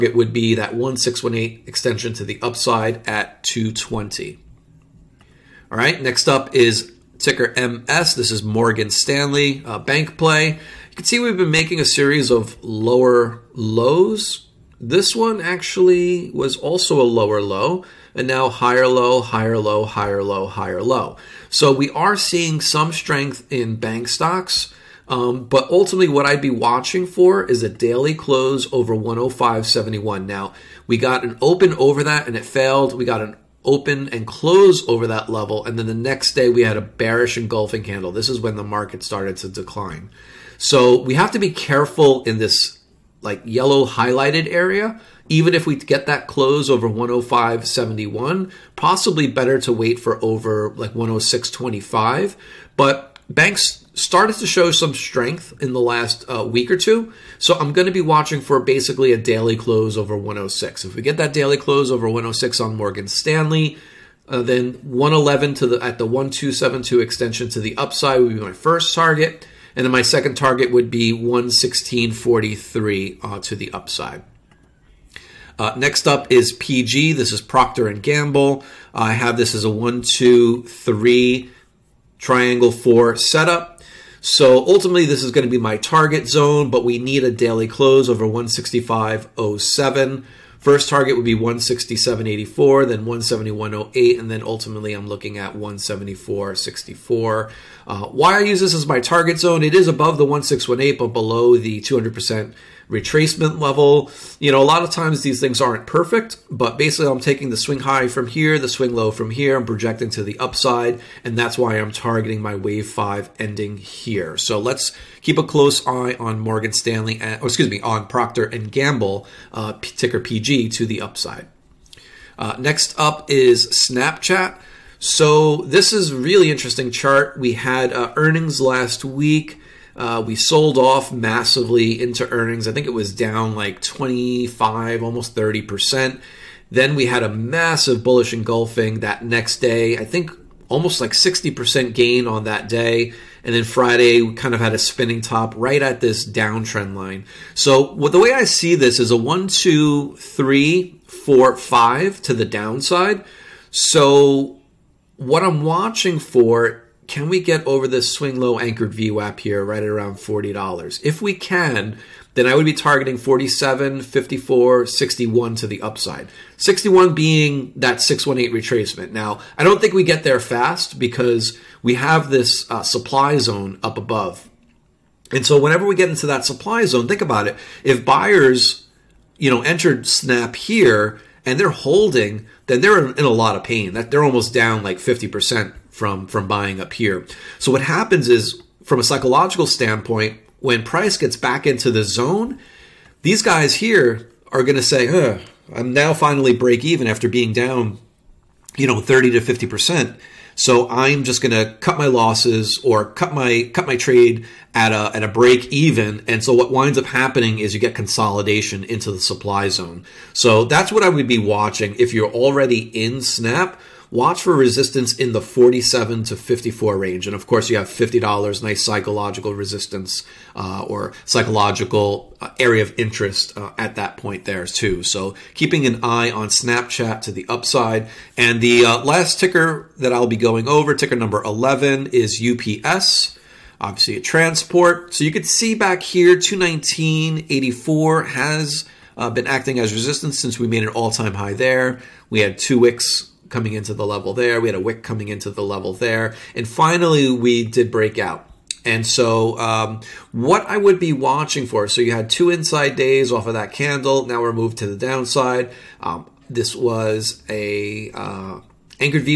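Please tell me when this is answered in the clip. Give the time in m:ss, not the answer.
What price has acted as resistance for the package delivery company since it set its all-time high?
3:56.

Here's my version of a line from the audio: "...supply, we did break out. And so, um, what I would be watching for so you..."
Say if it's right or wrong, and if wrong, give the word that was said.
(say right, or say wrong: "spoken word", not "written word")
wrong: "finally", not "supply".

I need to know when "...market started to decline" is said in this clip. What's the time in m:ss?
0:38.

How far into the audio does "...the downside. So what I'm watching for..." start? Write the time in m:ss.
2:32.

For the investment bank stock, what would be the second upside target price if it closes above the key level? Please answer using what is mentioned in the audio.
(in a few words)
116.43.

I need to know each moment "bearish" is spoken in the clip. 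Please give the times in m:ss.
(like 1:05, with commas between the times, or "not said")
0:36.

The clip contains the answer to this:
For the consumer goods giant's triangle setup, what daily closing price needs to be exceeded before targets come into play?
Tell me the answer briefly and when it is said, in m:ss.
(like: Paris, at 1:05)
165.07, at 1:28.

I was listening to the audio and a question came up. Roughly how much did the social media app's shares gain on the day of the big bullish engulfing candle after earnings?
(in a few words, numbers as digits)
60%.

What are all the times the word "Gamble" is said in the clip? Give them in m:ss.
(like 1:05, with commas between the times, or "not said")
1:18, 1:58.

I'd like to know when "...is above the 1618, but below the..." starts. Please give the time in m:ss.
1:39.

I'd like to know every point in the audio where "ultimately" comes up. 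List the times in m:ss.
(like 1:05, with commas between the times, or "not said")
0:25, 1:24, 1:34.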